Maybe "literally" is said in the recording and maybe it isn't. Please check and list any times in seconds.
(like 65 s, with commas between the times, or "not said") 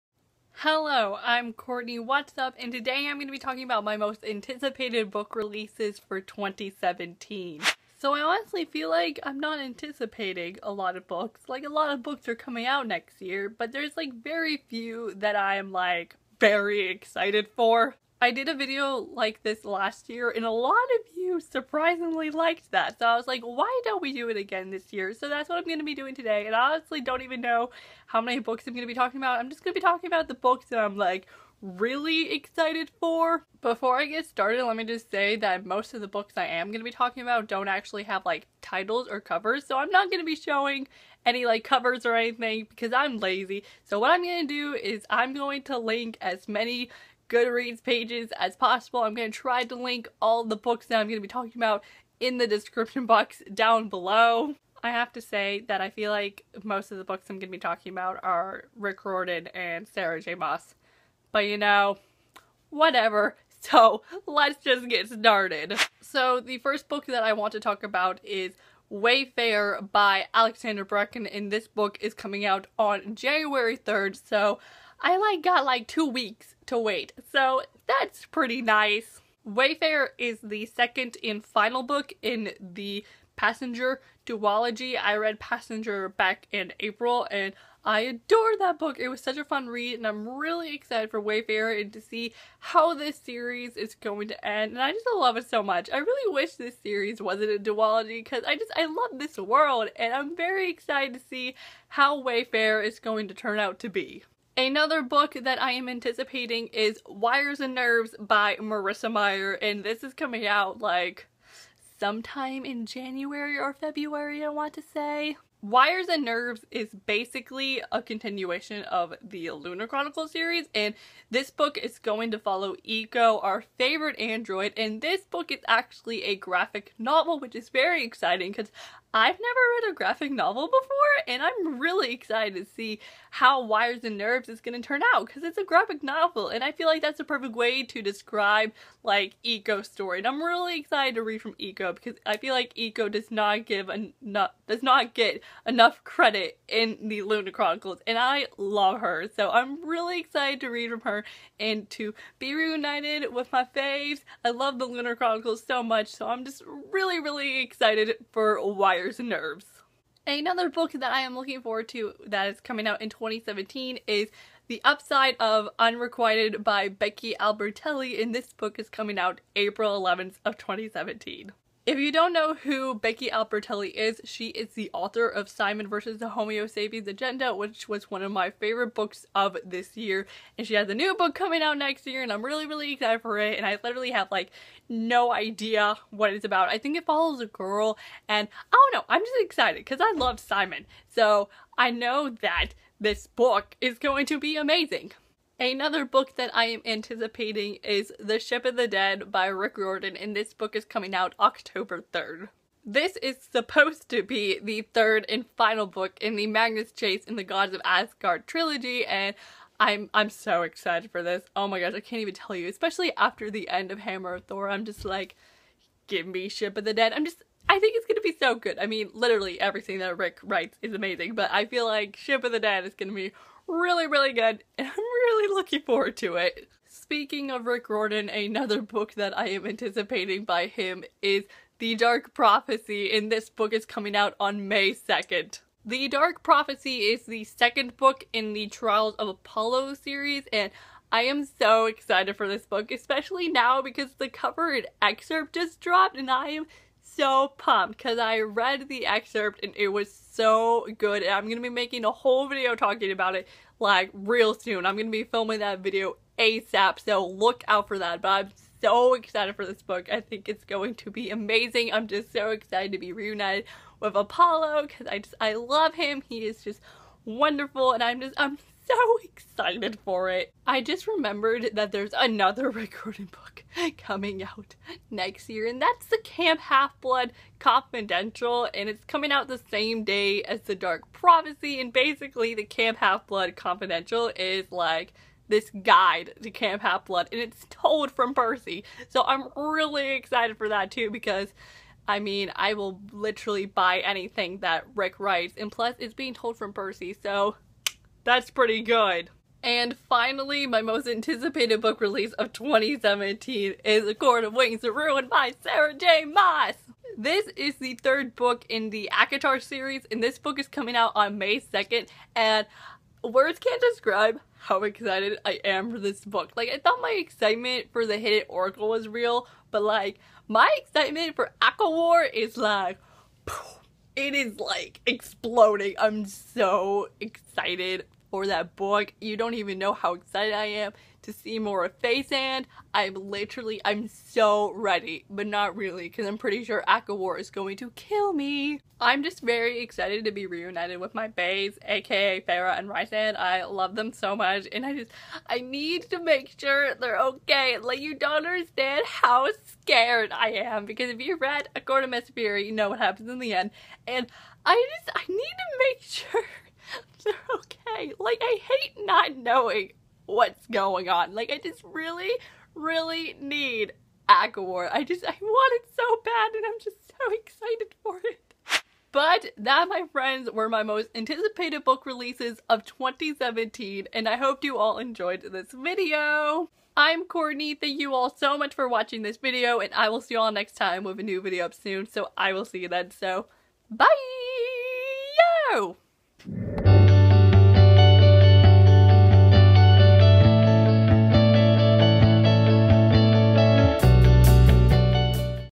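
183 s, 219 s, 293 s, 333 s.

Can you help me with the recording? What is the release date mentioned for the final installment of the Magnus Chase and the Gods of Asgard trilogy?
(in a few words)
October 3rd.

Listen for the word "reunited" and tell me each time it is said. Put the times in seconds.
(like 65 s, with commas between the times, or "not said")
152 s, 263 s, 340 s.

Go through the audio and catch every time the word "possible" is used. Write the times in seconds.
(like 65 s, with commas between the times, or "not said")
48 s.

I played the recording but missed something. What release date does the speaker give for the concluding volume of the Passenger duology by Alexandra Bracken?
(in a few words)
January 3rd.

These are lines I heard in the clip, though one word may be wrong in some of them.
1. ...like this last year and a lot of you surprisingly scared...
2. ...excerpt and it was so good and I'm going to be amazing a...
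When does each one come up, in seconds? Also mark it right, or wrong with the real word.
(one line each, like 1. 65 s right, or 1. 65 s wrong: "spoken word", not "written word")
1. 19 s wrong: "liked", not "scared"
2. 249 s wrong: "making", not "amazing".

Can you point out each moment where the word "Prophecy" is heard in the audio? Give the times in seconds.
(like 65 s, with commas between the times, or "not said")
232 s, 236 s, 281 s.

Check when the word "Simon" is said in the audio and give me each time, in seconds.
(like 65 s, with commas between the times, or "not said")
175 s, 190 s.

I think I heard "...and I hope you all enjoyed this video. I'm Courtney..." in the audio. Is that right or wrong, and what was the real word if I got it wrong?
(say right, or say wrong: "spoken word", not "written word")
right.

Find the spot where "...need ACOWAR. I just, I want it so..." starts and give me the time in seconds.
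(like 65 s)
363 s.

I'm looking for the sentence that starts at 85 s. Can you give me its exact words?
I read Passenger back in April and I adored that book.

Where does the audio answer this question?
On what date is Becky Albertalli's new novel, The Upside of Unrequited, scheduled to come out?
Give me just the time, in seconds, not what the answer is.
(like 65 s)
169 s.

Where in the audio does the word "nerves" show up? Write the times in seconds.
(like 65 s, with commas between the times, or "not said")
107 s, 116 s, 134 s, 159 s.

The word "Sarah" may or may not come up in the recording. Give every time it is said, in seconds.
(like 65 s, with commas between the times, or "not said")
59 s, 305 s.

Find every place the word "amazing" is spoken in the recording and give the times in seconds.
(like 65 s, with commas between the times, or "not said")
194 s, 220 s, 261 s.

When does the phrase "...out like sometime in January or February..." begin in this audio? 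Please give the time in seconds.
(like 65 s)
110 s.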